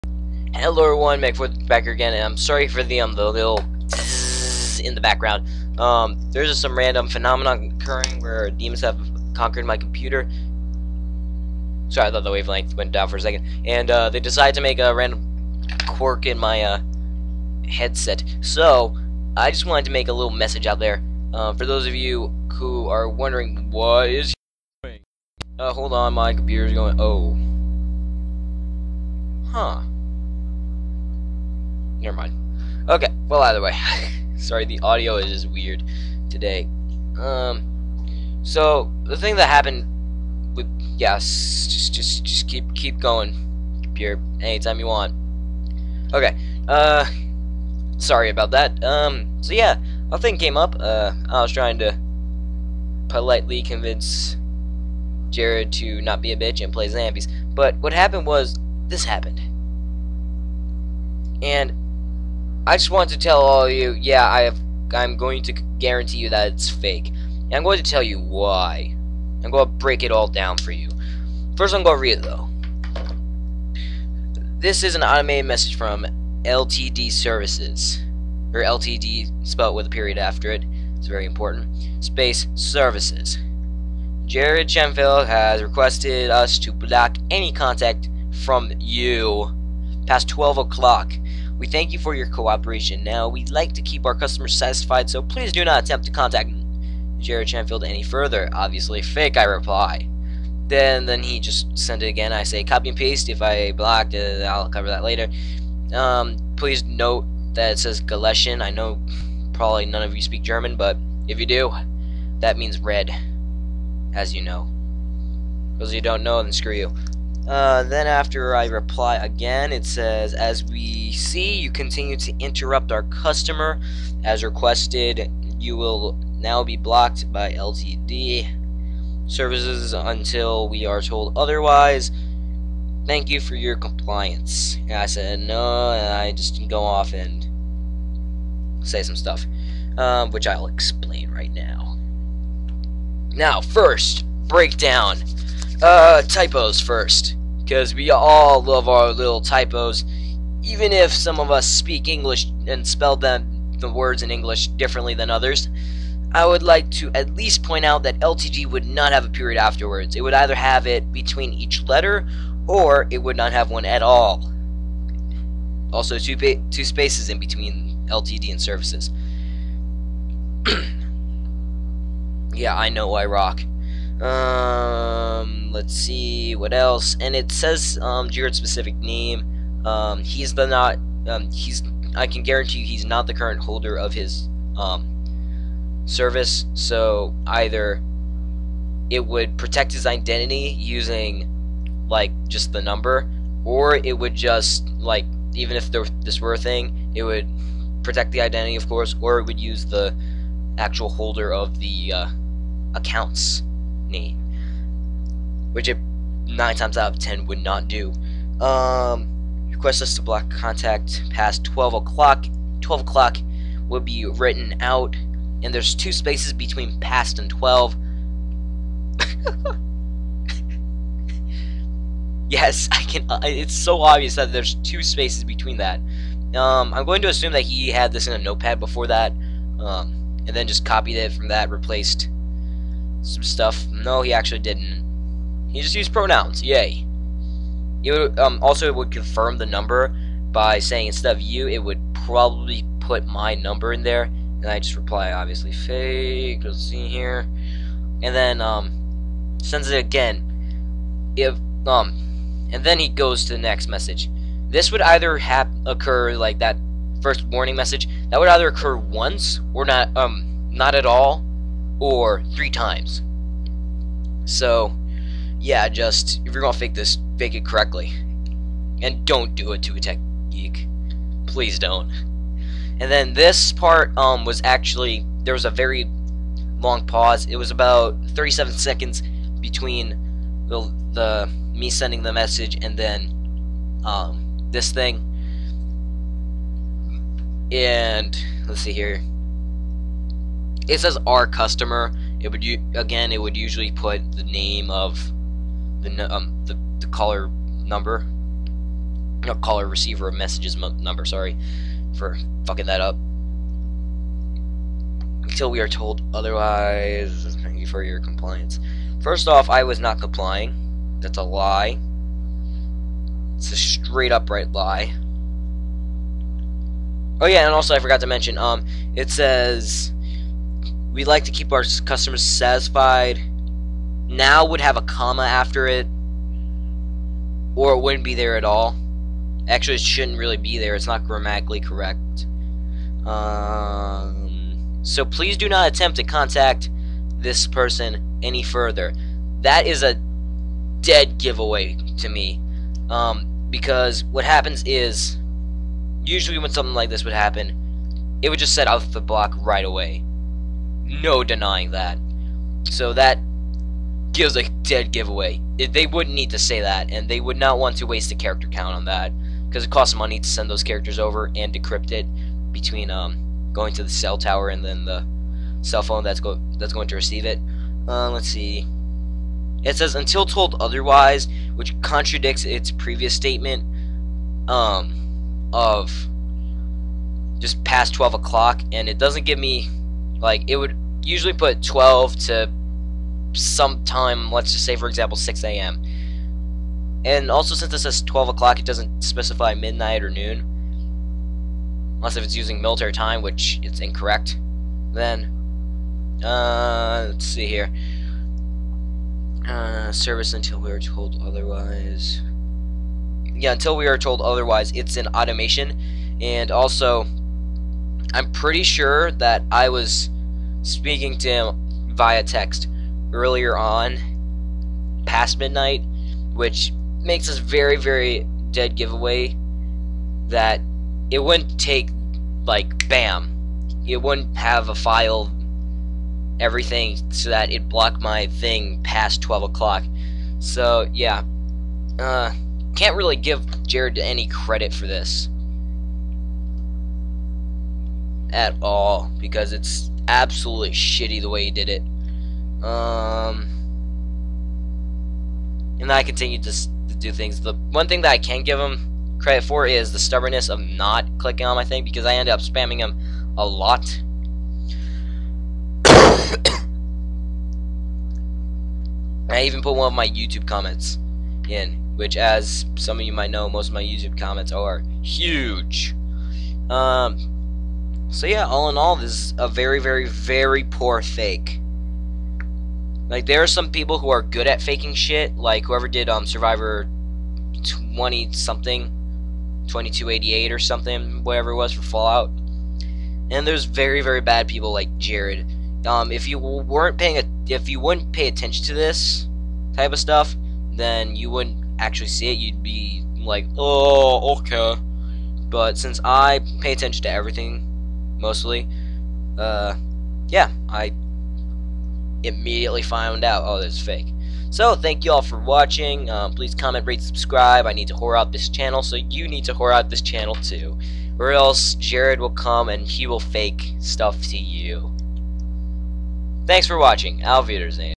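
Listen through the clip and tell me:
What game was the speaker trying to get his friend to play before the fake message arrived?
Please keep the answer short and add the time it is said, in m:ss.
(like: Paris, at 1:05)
Zombies, at 0:56.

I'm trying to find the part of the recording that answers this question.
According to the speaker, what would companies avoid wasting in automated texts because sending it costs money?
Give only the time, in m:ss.
5:58.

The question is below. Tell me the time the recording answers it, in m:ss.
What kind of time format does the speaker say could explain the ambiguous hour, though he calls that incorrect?
6:32.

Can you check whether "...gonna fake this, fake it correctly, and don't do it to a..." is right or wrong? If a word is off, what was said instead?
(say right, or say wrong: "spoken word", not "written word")
right.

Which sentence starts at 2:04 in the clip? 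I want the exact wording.
As requested, you will now be blocked by LTD services until we are told otherwise.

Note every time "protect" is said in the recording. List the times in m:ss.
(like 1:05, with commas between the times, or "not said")
3:09, 3:18.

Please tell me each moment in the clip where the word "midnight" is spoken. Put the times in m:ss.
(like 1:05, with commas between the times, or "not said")
6:29, 6:55.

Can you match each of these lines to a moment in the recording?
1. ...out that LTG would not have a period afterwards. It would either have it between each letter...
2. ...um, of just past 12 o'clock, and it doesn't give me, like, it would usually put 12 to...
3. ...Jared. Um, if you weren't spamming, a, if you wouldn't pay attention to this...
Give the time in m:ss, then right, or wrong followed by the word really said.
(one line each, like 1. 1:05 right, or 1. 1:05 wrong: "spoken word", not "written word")
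1. 2:37 right
2. 6:14 right
3. 8:05 wrong: "paying", not "spamming".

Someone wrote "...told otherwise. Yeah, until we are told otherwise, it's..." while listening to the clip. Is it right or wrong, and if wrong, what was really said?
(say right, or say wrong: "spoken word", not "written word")
right.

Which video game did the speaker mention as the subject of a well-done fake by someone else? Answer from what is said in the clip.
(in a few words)
Fallout.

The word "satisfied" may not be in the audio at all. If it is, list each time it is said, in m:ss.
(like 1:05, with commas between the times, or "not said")
1:34, 5:22.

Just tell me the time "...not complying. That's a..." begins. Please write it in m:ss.
5:09.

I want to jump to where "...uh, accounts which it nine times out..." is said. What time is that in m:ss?
3:22.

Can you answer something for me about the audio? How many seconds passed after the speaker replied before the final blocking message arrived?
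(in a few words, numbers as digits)
37.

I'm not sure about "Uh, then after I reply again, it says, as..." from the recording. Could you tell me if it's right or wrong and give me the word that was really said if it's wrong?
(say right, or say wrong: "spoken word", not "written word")
right.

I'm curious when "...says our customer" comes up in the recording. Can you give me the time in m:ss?
4:50.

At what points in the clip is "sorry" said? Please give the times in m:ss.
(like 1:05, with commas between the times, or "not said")
0:02, 0:11, 0:34, 0:47, 5:01.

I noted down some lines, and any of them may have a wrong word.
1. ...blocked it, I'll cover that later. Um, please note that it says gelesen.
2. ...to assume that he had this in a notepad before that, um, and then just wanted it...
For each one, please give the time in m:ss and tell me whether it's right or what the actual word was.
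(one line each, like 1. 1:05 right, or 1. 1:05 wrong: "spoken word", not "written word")
1. 1:43 right
2. 3:47 wrong: "copied", not "wanted".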